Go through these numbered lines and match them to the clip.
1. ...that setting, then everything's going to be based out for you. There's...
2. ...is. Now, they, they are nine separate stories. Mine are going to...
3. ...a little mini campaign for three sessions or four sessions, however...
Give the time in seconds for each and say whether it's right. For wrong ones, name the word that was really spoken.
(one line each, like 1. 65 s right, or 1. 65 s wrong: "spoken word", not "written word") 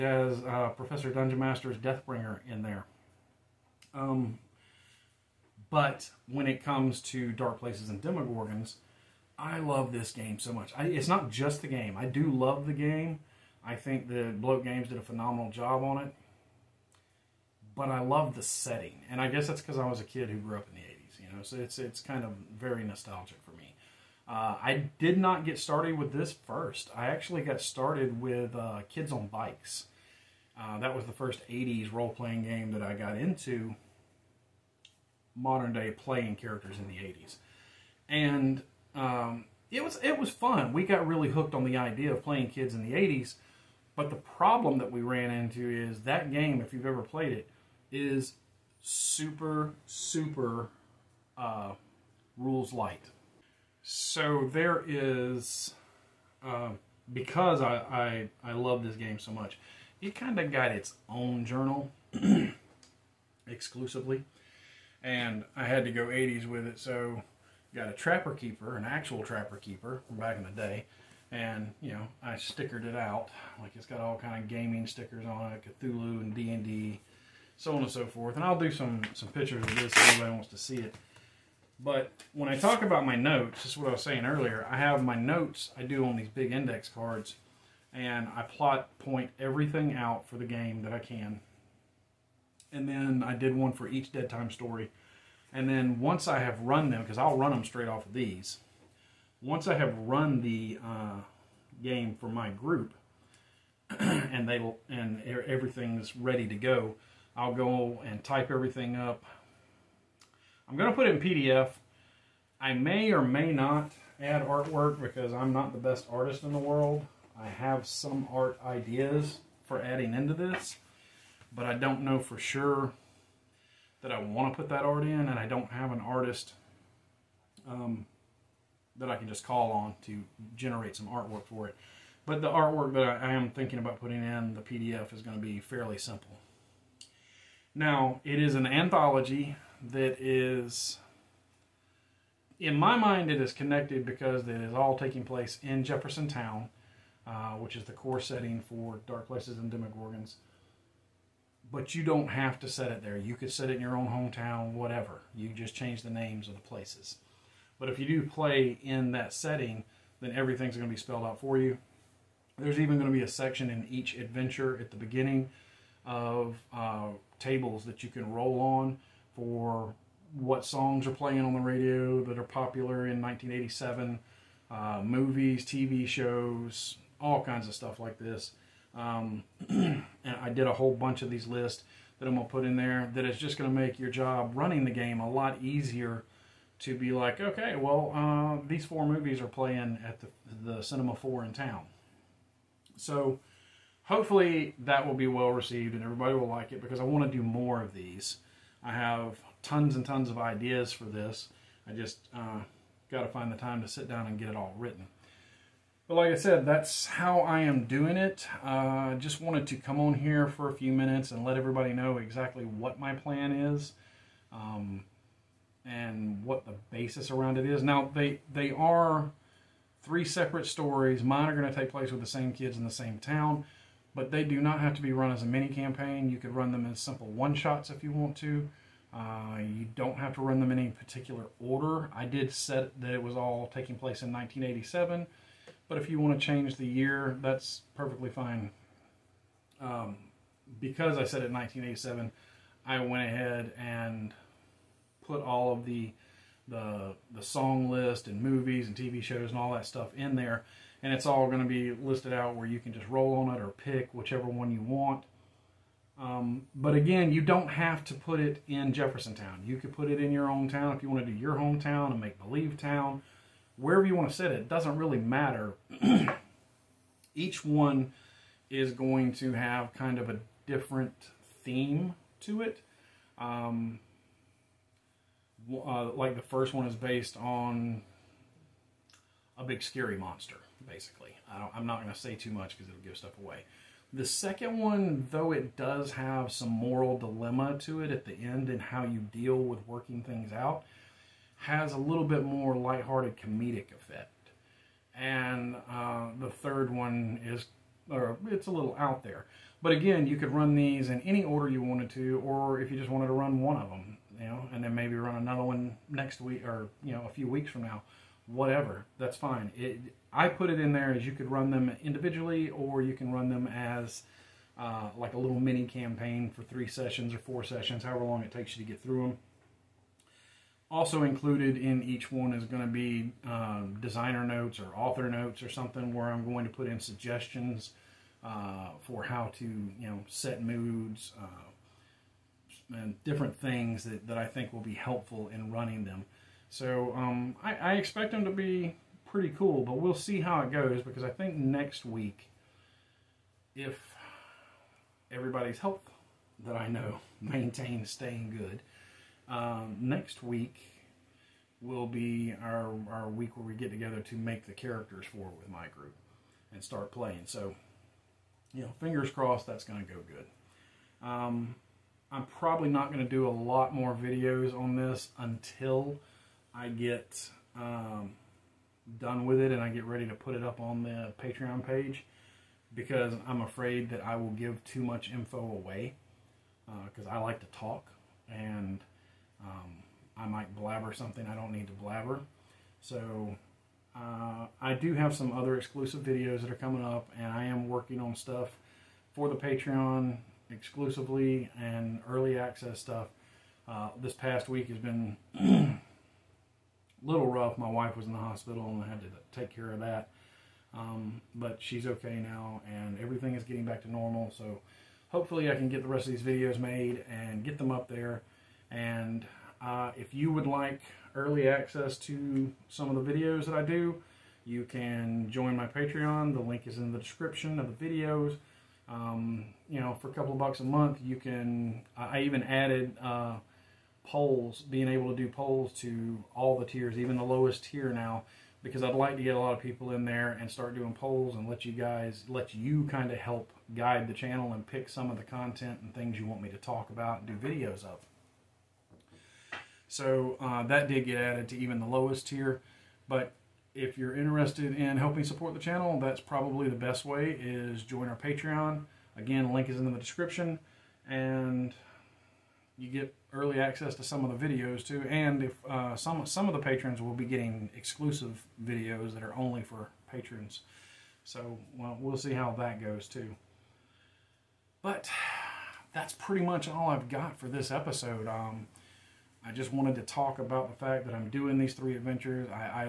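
1. 159 s wrong: "spelled", not "based"
2. 217 s wrong: "three", not "nine"
3. 315 s right.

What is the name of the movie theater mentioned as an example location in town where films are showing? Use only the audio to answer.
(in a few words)
Cinema 4.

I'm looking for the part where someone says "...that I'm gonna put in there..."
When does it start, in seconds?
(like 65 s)
182 s.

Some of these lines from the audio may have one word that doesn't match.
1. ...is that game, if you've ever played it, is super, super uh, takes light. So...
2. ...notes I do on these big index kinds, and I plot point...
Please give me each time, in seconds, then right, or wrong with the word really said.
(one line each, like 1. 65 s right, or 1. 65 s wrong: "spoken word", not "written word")
1. 45 s wrong: "rules", not "takes"
2. 85 s wrong: "cards", not "kinds".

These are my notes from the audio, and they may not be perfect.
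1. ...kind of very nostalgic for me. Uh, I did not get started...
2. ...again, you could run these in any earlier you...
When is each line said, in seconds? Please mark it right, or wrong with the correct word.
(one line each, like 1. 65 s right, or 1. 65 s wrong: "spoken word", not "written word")
1. 21 s right
2. 299 s wrong: "order", not "earlier".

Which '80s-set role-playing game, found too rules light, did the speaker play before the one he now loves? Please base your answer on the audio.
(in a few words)
Kids on Bikes.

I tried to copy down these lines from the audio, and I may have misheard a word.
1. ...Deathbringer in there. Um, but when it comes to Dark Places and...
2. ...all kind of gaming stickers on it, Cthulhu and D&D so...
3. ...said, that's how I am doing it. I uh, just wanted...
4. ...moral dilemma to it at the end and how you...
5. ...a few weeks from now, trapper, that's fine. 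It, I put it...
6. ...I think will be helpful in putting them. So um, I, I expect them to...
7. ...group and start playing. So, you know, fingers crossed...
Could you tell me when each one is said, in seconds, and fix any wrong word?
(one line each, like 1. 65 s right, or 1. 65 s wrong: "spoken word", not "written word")
1. 1 s right
2. 73 s right
3. 206 s right
4. 286 s right
5. 307 s wrong: "whatever", not "trapper"
6. 334 s wrong: "running", not "putting"
7. 355 s right.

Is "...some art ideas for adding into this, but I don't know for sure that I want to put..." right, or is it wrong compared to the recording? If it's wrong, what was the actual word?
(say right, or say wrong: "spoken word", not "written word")
right.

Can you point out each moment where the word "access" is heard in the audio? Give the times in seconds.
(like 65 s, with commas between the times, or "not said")
392 s, 411 s, 453 s.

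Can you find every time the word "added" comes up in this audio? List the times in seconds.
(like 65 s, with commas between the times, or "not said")
422 s, 441 s.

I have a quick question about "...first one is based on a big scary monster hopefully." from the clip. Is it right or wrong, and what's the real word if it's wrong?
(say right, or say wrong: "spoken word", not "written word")
wrong: "basically", not "hopefully".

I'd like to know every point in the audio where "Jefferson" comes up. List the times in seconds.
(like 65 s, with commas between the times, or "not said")
145 s, 258 s.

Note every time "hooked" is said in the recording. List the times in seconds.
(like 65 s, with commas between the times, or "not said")
41 s.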